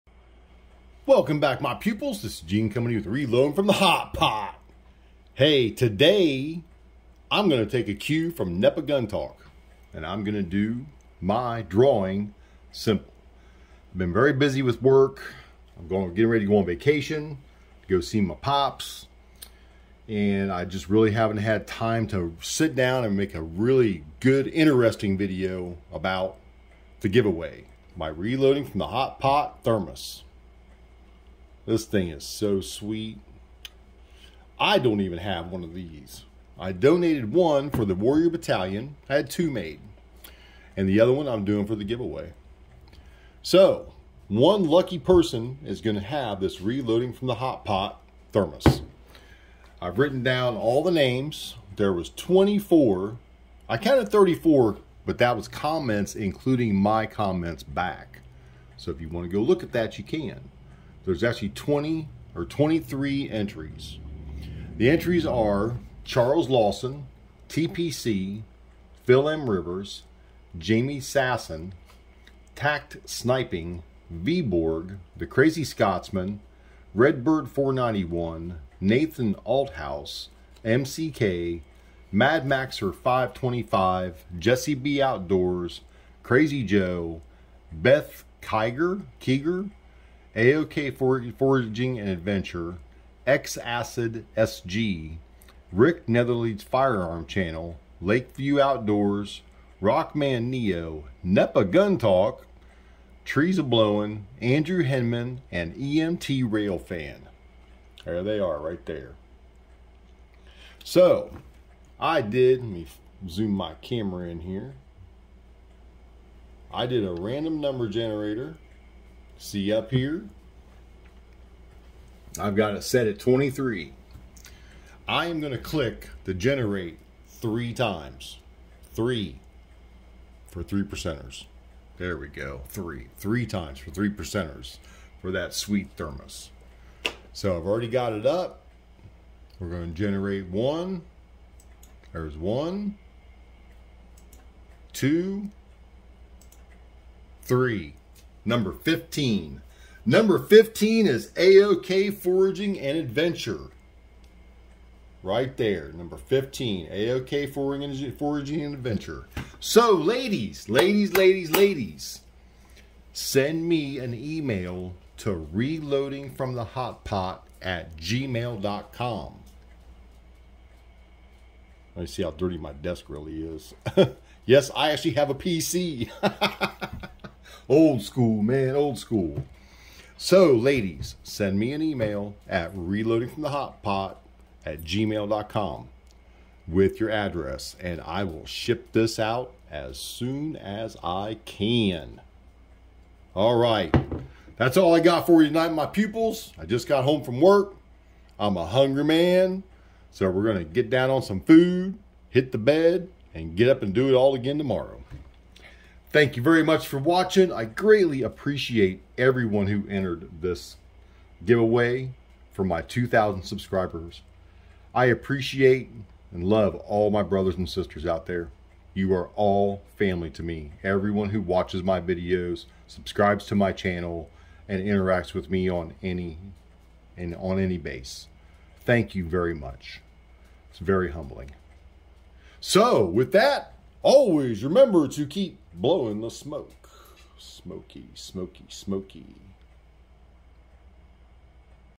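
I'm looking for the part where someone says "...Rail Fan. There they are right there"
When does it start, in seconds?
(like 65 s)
106 s.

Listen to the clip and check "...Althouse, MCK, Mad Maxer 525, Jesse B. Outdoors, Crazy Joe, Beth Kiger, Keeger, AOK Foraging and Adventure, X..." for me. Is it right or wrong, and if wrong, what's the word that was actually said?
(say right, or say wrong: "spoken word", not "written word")
right.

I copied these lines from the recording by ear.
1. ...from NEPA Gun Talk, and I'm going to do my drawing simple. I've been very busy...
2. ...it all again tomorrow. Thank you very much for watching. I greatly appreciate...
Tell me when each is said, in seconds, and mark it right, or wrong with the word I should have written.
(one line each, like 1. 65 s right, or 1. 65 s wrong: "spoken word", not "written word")
1. 8 s right
2. 204 s right.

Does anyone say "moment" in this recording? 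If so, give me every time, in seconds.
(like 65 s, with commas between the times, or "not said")
not said.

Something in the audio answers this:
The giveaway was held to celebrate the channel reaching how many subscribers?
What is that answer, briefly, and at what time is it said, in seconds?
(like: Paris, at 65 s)
2,000, at 212 s.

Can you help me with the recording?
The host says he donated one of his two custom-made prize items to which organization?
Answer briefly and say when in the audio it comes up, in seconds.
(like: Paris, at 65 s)
Warrior Battalion, at 37 s.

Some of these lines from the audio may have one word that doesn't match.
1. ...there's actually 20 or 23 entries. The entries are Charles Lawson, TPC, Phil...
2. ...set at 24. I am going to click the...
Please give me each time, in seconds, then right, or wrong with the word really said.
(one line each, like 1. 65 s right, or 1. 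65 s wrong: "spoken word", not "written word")
1. 61 s right
2. 122 s wrong: "23", not "24".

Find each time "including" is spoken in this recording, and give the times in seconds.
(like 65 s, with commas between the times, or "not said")
56 s.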